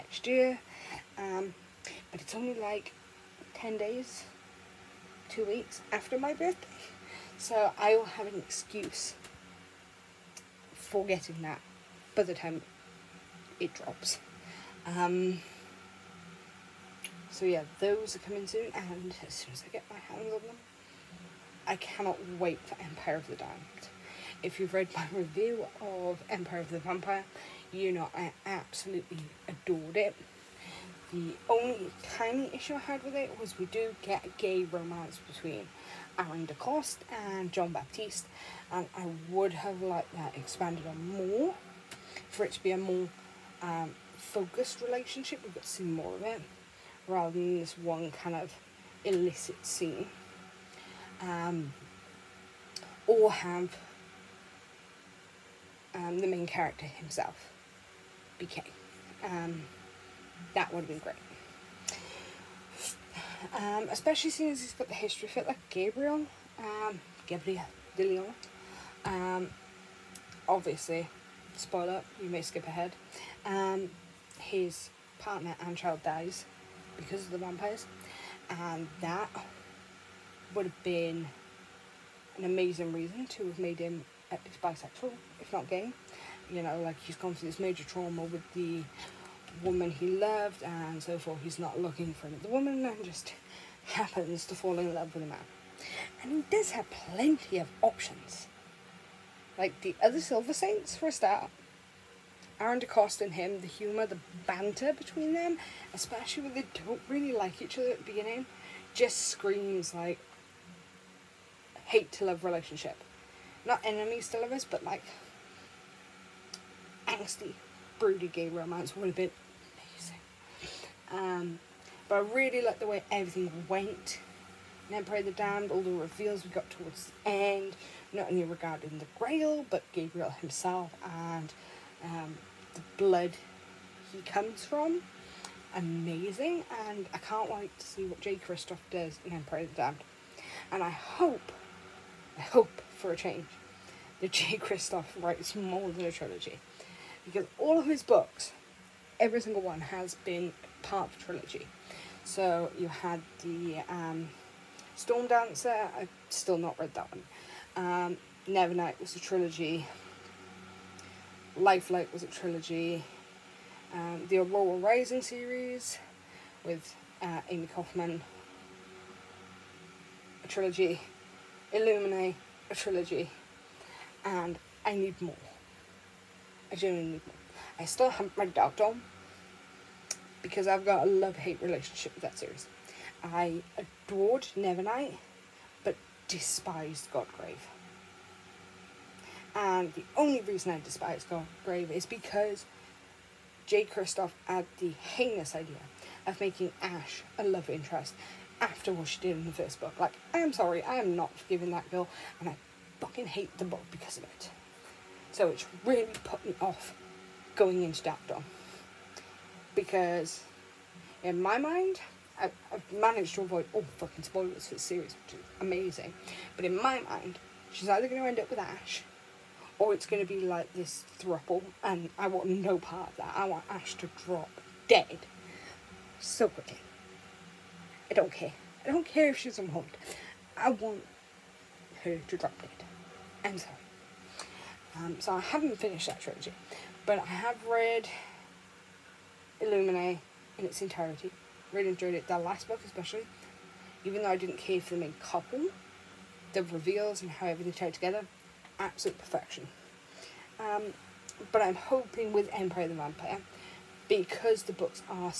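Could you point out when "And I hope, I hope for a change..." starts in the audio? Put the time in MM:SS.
02:20.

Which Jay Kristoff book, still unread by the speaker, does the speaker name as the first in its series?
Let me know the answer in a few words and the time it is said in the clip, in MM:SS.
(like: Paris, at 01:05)
Storm Dancer, at 02:34.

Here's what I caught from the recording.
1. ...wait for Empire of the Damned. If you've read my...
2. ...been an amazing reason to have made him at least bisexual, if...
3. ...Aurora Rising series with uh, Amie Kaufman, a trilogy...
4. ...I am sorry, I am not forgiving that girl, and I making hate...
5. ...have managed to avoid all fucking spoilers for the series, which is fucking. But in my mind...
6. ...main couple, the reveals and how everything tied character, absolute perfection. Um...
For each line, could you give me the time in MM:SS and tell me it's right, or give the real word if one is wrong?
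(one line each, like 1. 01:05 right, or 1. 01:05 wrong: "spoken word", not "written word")
1. 00:22 right
2. 01:20 right
3. 02:44 right
4. 03:20 wrong: "fucking", not "making"
5. 03:32 wrong: "amazing", not "fucking"
6. 04:04 wrong: "together", not "character".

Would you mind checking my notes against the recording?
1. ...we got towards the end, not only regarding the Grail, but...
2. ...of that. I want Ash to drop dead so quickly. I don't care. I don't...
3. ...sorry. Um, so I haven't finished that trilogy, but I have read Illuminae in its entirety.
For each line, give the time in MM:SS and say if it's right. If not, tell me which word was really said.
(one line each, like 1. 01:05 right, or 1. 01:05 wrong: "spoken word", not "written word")
1. 02:06 right
2. 03:43 right
3. 03:53 right.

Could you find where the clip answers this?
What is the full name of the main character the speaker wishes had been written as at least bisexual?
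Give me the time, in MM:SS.
01:07.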